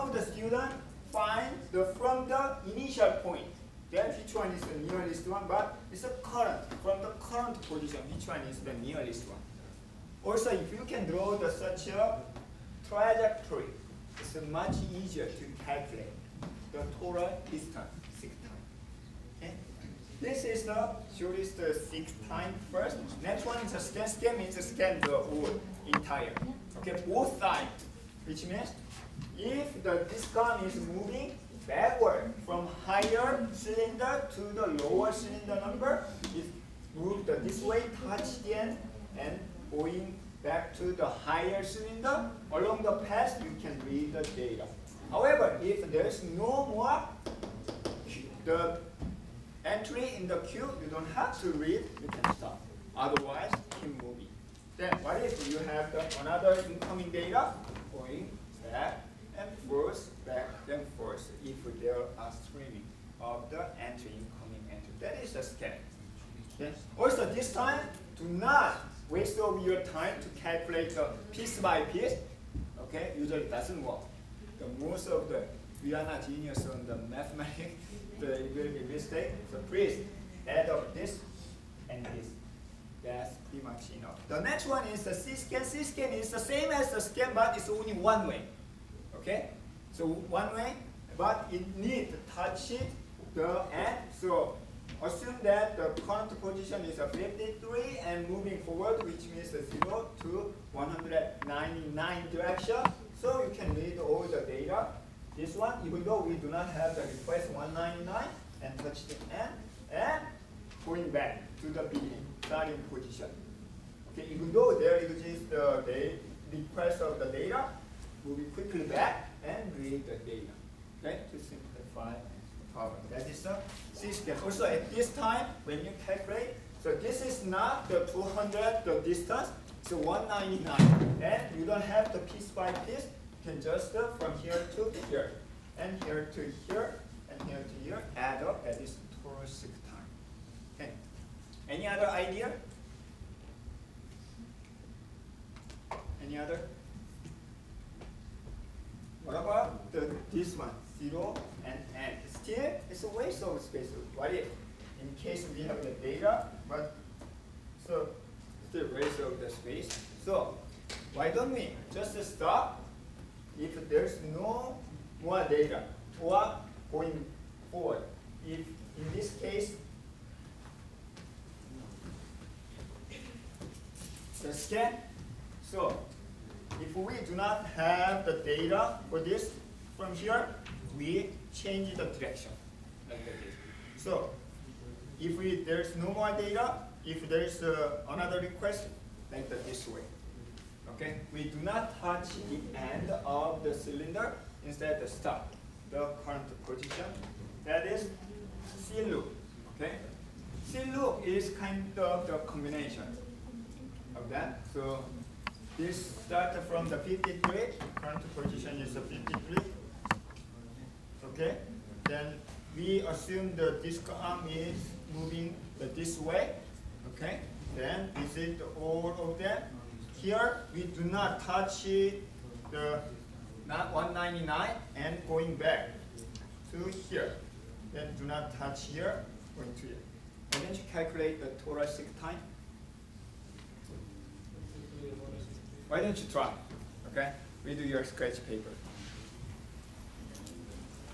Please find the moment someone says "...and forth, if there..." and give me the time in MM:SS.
01:00.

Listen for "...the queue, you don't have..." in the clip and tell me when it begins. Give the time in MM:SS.
00:50.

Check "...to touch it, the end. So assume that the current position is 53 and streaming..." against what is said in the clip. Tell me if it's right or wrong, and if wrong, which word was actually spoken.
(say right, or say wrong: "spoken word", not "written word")
wrong: "moving", not "streaming".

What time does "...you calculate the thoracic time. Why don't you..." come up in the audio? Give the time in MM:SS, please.
03:50.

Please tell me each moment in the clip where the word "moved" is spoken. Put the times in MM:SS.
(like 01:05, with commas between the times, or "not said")
00:36.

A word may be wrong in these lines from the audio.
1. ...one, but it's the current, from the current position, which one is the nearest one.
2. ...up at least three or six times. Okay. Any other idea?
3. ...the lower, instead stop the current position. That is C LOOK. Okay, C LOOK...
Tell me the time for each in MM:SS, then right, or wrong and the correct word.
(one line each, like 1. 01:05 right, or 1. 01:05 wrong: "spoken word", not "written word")
1. 00:05 right
2. 02:18 wrong: "four", not "three"
3. 03:13 wrong: "cylinder", not "lower".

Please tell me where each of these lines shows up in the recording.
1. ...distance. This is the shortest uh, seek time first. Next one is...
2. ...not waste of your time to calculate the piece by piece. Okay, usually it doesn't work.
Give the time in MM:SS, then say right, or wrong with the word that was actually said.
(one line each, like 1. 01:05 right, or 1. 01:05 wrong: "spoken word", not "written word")
1. 00:17 right
2. 01:08 right.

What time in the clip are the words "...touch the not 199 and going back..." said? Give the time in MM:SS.
03:41.